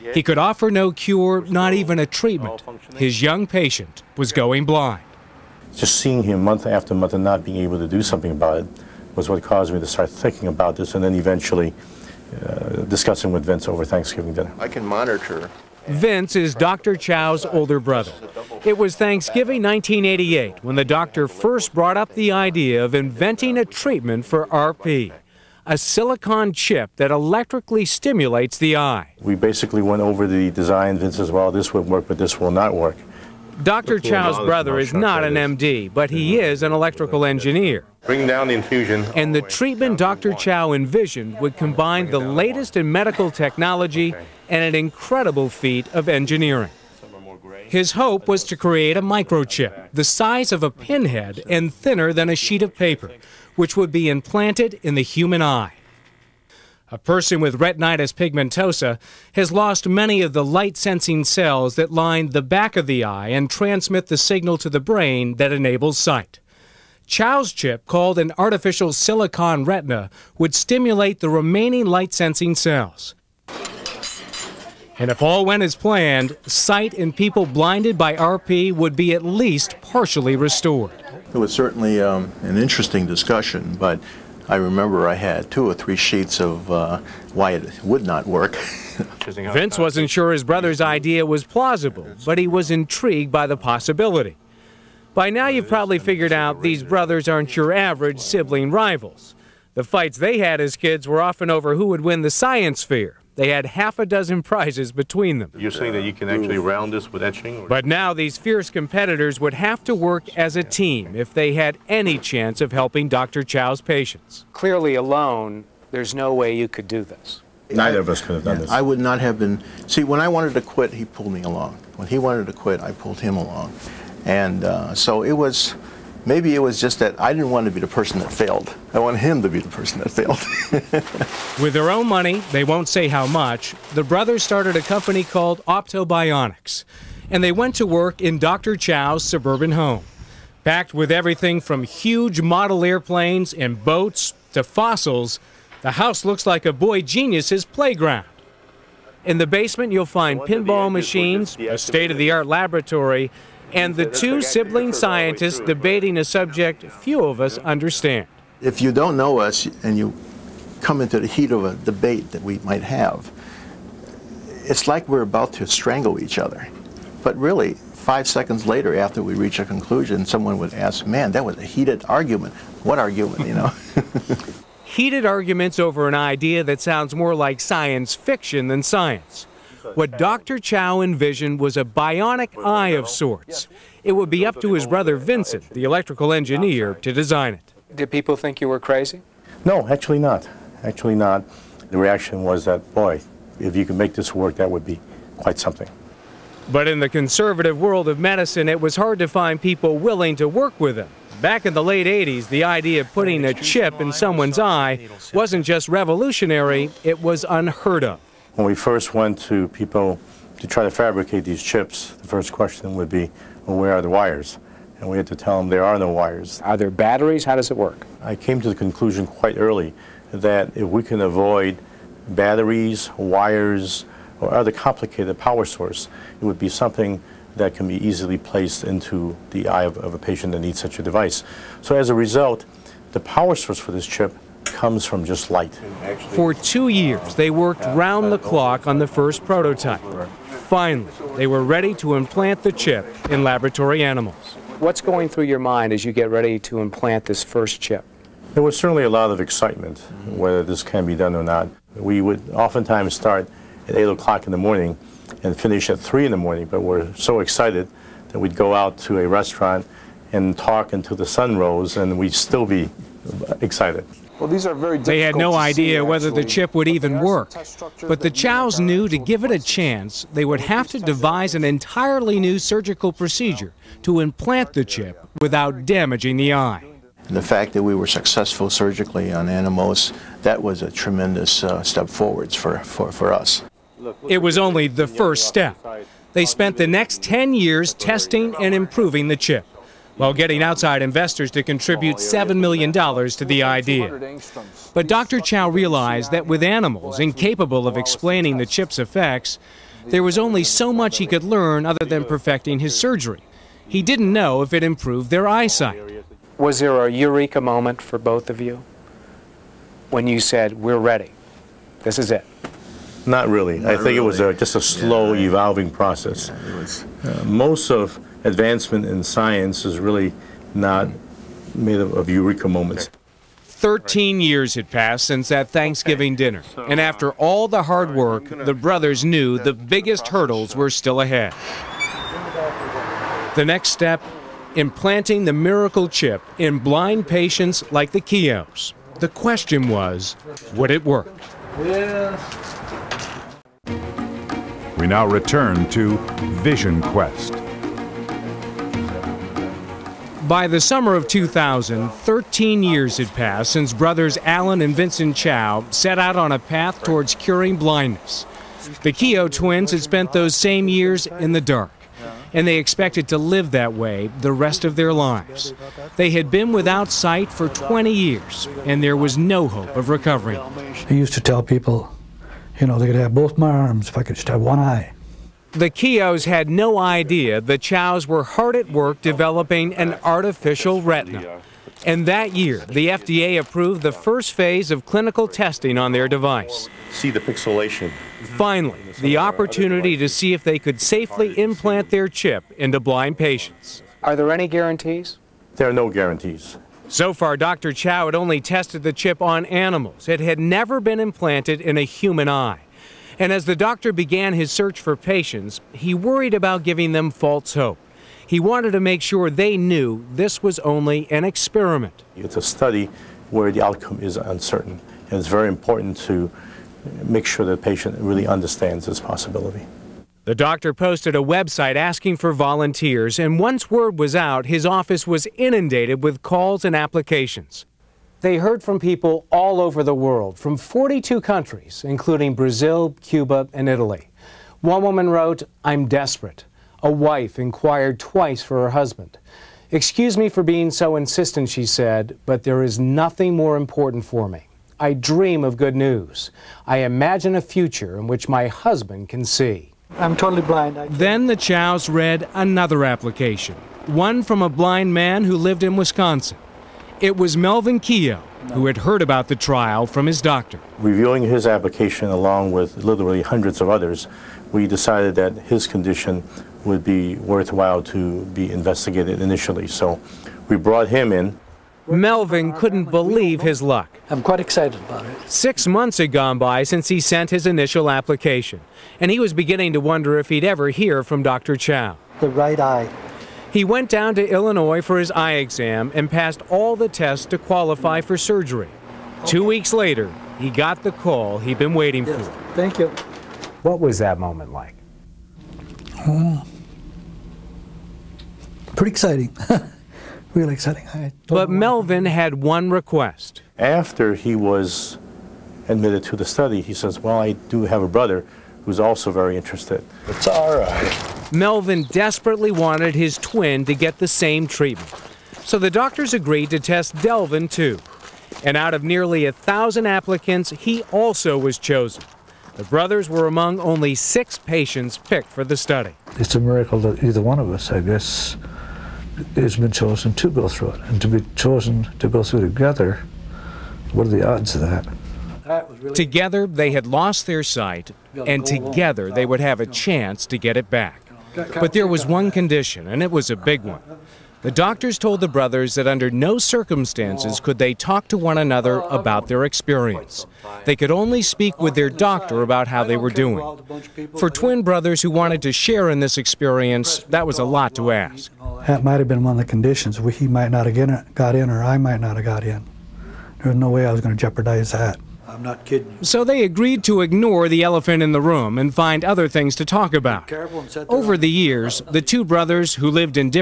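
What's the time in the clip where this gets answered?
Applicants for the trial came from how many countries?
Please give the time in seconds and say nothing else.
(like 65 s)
430 s.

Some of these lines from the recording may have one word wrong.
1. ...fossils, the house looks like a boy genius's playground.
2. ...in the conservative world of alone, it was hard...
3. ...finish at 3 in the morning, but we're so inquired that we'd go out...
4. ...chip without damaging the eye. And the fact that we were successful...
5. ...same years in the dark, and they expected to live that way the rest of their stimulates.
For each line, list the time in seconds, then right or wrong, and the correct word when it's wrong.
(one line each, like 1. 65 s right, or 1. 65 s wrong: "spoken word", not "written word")
1. 144 s right
2. 196 s wrong: "medicine", not "alone"
3. 255 s wrong: "excited", not "inquired"
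4. 274 s right
5. 360 s wrong: "lives", not "stimulates".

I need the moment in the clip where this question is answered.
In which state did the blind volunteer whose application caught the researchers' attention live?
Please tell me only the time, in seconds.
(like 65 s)
455 s.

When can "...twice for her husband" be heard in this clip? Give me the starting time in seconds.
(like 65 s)
438 s.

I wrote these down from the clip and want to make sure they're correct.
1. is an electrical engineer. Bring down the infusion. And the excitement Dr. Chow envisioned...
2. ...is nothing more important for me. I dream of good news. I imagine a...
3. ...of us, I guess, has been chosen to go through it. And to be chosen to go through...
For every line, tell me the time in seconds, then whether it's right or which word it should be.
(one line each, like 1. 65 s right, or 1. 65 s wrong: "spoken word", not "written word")
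1. 36 s wrong: "treatment", not "excitement"
2. 442 s right
3. 527 s right.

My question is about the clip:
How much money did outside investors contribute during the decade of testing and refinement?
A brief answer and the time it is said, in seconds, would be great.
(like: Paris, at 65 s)
$7 million, at 292 s.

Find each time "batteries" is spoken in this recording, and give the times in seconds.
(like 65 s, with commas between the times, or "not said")
216 s, 222 s.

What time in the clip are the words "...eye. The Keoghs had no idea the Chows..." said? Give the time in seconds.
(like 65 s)
374 s.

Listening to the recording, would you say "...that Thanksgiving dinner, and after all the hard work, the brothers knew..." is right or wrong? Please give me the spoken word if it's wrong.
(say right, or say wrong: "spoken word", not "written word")
right.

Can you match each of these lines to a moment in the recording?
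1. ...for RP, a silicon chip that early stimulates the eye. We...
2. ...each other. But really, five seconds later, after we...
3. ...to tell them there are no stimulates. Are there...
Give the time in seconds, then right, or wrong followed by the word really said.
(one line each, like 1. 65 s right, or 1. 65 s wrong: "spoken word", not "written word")
1. 24 s wrong: "electrically", not "early"
2. 166 s right
3. 215 s wrong: "wires", not "stimulates".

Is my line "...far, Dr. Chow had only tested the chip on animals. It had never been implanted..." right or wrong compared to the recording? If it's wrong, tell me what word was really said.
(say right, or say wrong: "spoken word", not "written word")
right.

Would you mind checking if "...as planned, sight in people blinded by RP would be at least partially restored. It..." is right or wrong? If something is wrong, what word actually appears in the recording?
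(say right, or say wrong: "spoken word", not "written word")
right.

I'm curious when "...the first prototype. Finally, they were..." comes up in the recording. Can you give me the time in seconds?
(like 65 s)
238 s.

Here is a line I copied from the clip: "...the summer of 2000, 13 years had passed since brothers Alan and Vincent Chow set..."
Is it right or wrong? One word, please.
right.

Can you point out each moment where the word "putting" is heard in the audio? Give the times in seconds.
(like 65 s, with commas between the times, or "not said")
203 s.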